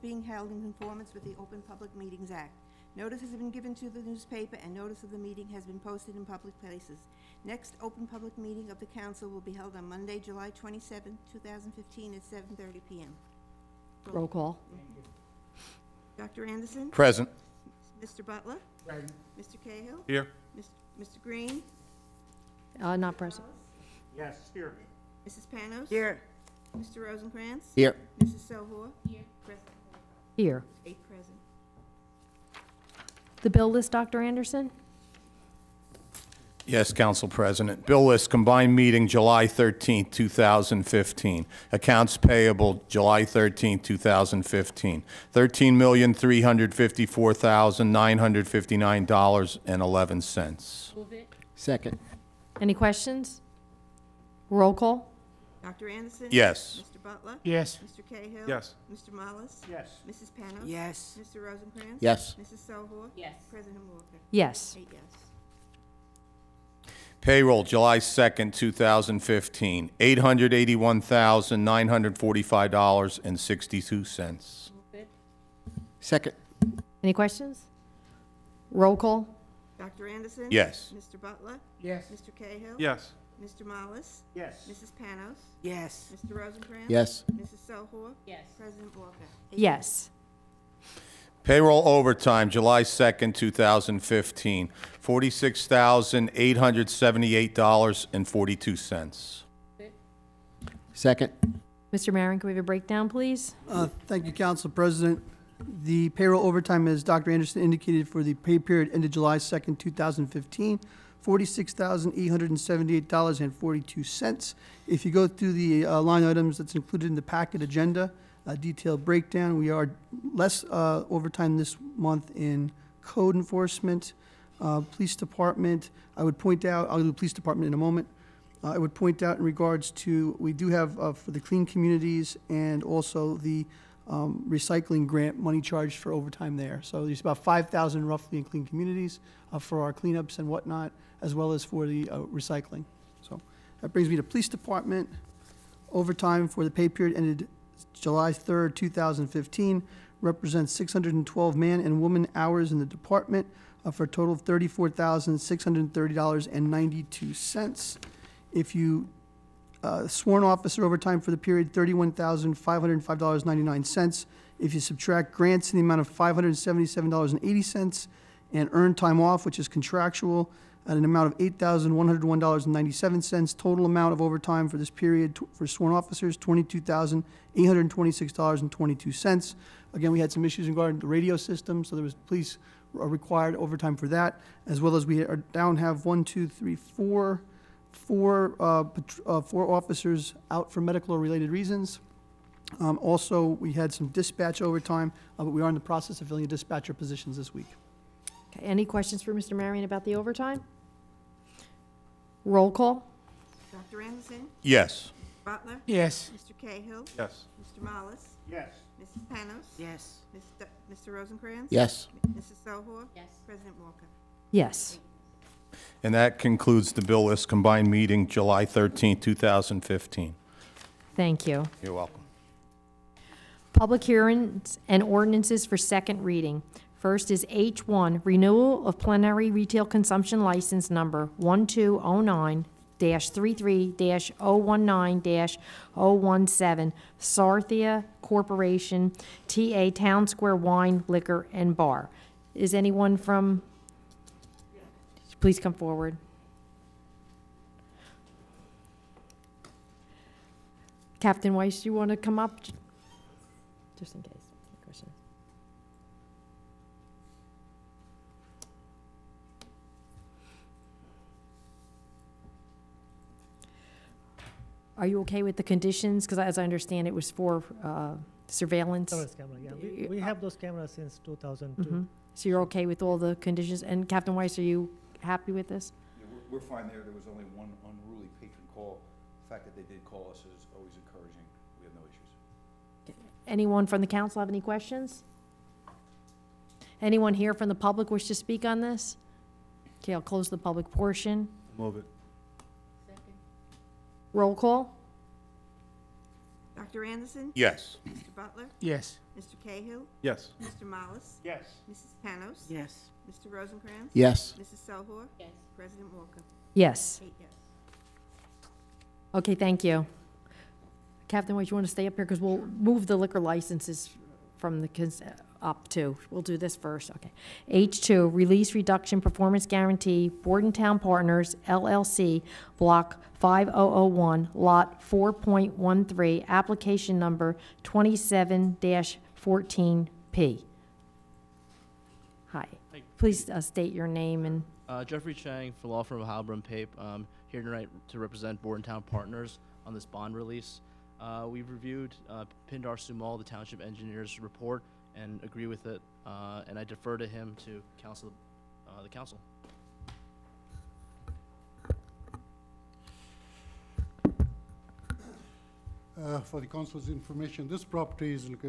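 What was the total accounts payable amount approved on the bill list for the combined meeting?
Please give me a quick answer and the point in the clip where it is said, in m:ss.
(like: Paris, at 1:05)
$13,354,959.11, at 0:45.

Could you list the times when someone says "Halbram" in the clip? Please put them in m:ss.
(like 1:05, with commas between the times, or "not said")
5:36.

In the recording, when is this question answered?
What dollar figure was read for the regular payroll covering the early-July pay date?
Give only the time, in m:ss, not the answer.
1:09.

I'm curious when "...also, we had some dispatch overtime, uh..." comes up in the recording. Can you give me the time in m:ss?
3:12.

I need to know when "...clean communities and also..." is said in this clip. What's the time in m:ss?
2:11.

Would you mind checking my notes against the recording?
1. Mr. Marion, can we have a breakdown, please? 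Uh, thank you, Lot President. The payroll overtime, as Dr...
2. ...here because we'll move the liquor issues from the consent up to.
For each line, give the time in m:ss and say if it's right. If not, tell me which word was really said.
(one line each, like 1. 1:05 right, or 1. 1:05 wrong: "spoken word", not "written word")
1. 1:41 wrong: "Council", not "Lot"
2. 5:12 wrong: "licenses", not "issues".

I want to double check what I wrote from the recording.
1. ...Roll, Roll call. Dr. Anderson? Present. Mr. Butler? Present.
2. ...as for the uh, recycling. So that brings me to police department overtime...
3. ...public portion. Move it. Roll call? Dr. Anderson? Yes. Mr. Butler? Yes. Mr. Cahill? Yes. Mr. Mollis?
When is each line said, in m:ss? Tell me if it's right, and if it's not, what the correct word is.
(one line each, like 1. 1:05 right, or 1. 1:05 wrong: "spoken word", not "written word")
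1. 0:14 right
2. 2:21 right
3. 4:50 right.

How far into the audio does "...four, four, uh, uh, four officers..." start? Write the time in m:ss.
3:06.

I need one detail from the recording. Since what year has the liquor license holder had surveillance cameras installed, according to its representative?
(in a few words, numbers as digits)
2002.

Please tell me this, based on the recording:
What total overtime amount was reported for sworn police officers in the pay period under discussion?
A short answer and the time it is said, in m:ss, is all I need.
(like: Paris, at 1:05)
$22,826.22, at 2:56.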